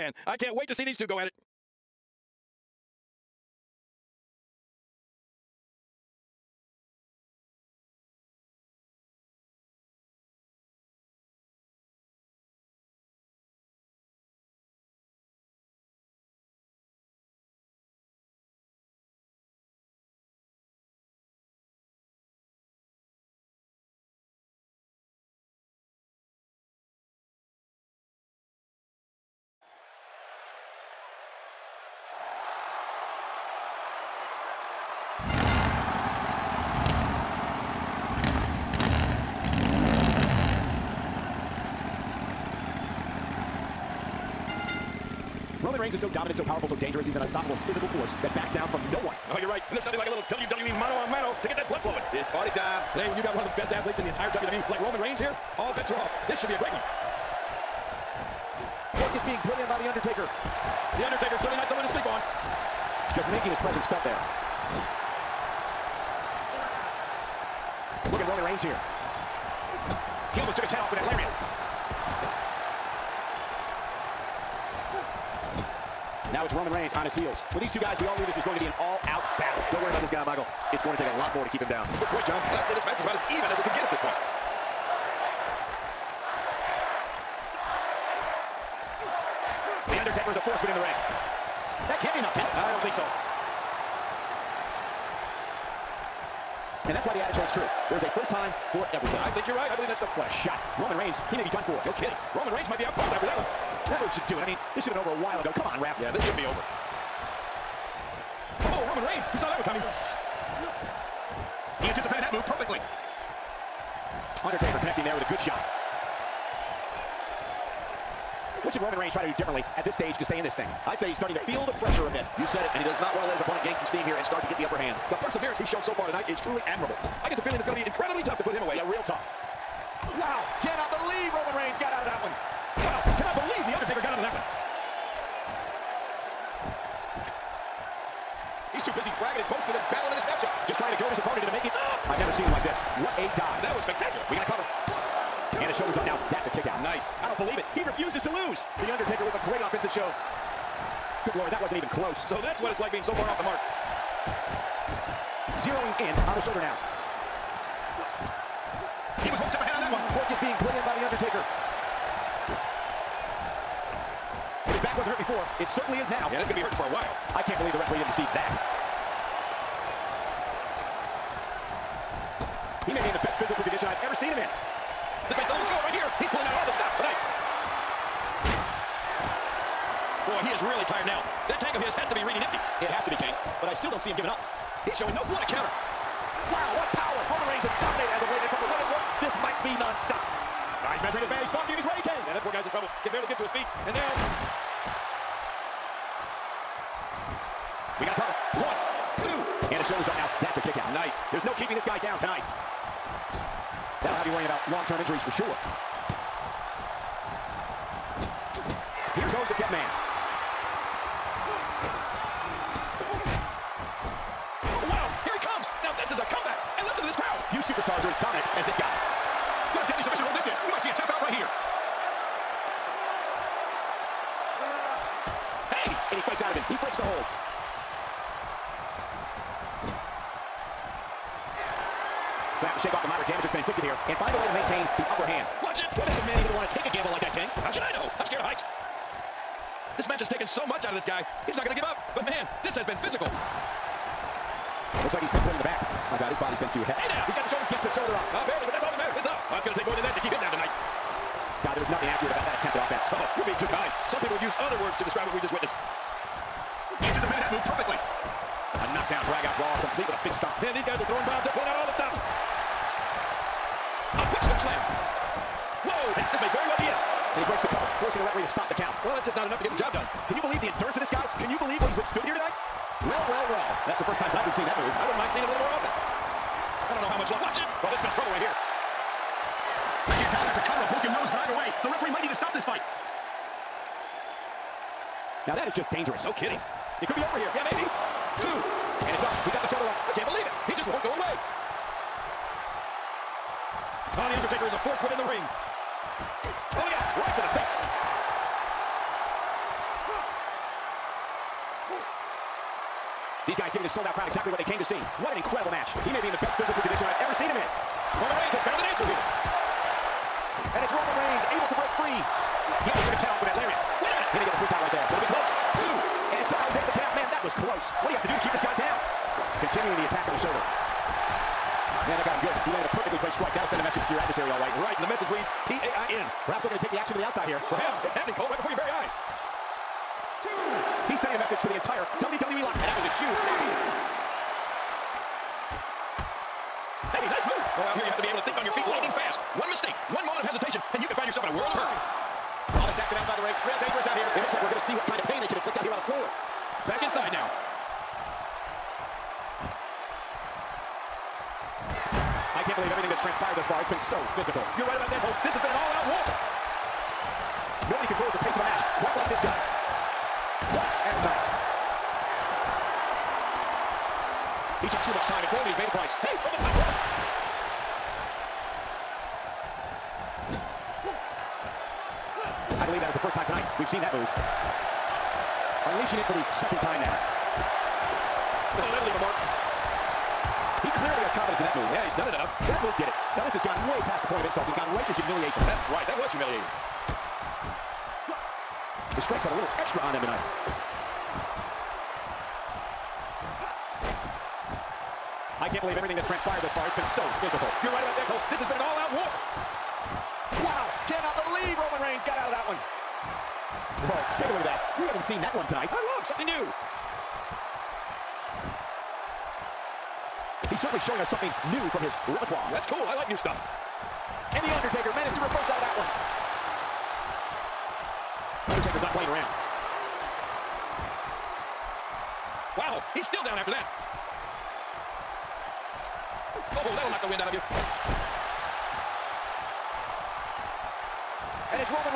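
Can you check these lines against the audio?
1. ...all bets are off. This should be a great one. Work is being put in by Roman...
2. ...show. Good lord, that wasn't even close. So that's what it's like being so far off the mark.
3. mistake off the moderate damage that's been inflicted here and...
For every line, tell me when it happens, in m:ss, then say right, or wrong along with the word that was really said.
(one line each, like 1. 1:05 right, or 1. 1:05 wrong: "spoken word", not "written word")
1. 0:55 wrong: "The", not "Roman"
2. 2:29 right
3. 3:52 wrong: "shake", not "mistake".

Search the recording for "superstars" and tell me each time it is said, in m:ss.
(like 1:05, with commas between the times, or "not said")
3:37.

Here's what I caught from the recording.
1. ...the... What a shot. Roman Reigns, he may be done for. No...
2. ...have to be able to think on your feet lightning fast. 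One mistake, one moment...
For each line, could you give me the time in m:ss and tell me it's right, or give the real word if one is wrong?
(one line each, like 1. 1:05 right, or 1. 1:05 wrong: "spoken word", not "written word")
1. 1:39 right
2. 5:38 right.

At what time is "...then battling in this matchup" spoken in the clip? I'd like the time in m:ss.
2:19.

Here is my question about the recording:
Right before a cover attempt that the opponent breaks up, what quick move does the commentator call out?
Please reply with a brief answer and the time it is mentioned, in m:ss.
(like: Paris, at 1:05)
scoop slam, at 4:24.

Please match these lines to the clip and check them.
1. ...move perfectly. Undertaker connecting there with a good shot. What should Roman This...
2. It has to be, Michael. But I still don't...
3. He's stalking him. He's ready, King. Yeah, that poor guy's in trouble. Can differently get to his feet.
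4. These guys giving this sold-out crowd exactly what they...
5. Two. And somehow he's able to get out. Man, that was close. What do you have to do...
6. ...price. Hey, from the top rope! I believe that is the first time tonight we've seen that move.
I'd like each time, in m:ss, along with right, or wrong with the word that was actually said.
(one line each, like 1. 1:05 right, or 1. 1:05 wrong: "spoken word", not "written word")
1. 1:52 wrong: "Reigns", not "This"
2. 3:02 wrong: "King", not "Michael"
3. 3:11 wrong: "barely", not "differently"
4. 5:03 right
5. 5:15 right
6. 6:05 right.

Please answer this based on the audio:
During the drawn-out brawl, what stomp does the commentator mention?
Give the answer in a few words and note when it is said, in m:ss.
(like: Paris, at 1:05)
big stomp, at 4:20.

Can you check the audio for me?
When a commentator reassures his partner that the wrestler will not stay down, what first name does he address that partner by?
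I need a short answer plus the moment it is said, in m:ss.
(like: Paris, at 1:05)
Michael, at 1:20.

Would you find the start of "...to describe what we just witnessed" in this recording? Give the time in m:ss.
4:14.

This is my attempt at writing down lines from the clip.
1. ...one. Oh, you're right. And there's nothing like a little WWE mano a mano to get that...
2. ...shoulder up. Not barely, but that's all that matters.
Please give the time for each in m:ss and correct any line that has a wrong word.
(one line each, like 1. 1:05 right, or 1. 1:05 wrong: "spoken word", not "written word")
1. 0:49 right
2. 4:07 right.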